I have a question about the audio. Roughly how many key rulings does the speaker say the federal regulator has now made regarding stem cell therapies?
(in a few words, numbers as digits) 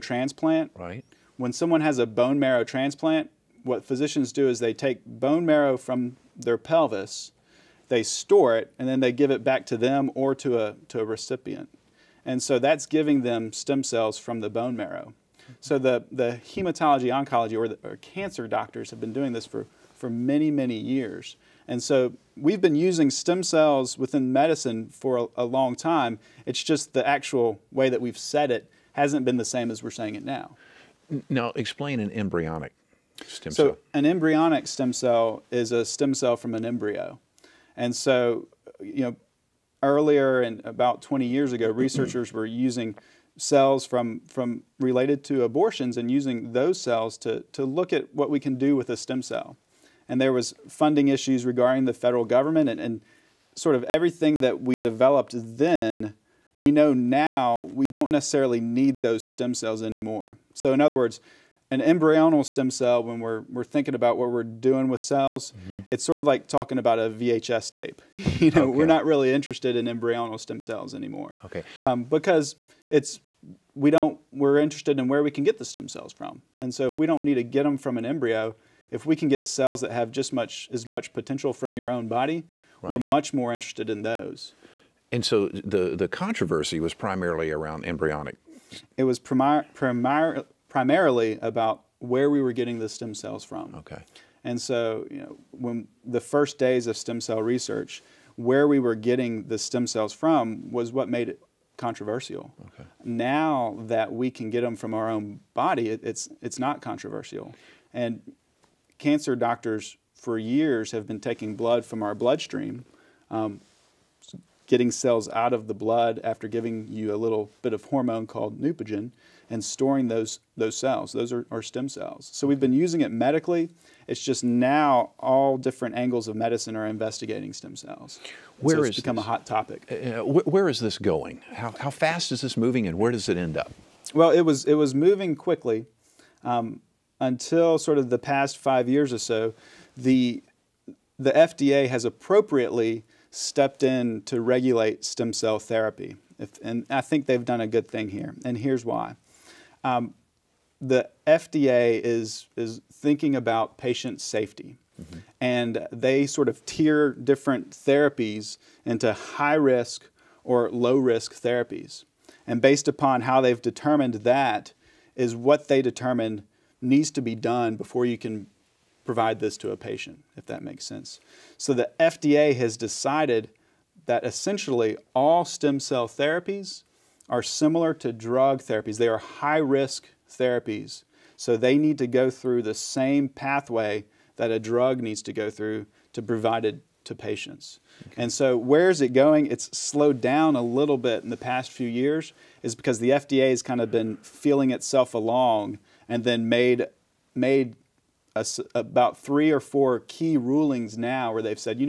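3 or 4.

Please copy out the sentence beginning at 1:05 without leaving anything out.
it's sort of like talking about a VHS tape.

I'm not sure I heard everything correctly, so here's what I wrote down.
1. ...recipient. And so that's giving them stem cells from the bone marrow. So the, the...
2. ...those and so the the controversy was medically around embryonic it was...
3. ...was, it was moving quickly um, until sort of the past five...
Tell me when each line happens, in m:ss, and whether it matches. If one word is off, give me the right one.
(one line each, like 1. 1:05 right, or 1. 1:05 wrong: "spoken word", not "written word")
1. 0:11 right
2. 1:24 wrong: "primarily", not "medically"
3. 2:14 right.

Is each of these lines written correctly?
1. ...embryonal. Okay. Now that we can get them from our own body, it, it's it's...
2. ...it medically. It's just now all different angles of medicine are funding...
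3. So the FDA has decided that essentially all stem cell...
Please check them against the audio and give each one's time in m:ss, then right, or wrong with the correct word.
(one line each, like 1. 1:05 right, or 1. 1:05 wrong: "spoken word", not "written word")
1. 1:41 wrong: "controversial", not "embryonal"
2. 2:02 wrong: "investigating", not "funding"
3. 2:51 right.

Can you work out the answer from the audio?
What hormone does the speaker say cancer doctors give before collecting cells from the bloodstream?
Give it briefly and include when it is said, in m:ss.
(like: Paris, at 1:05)
Neupogen, at 1:58.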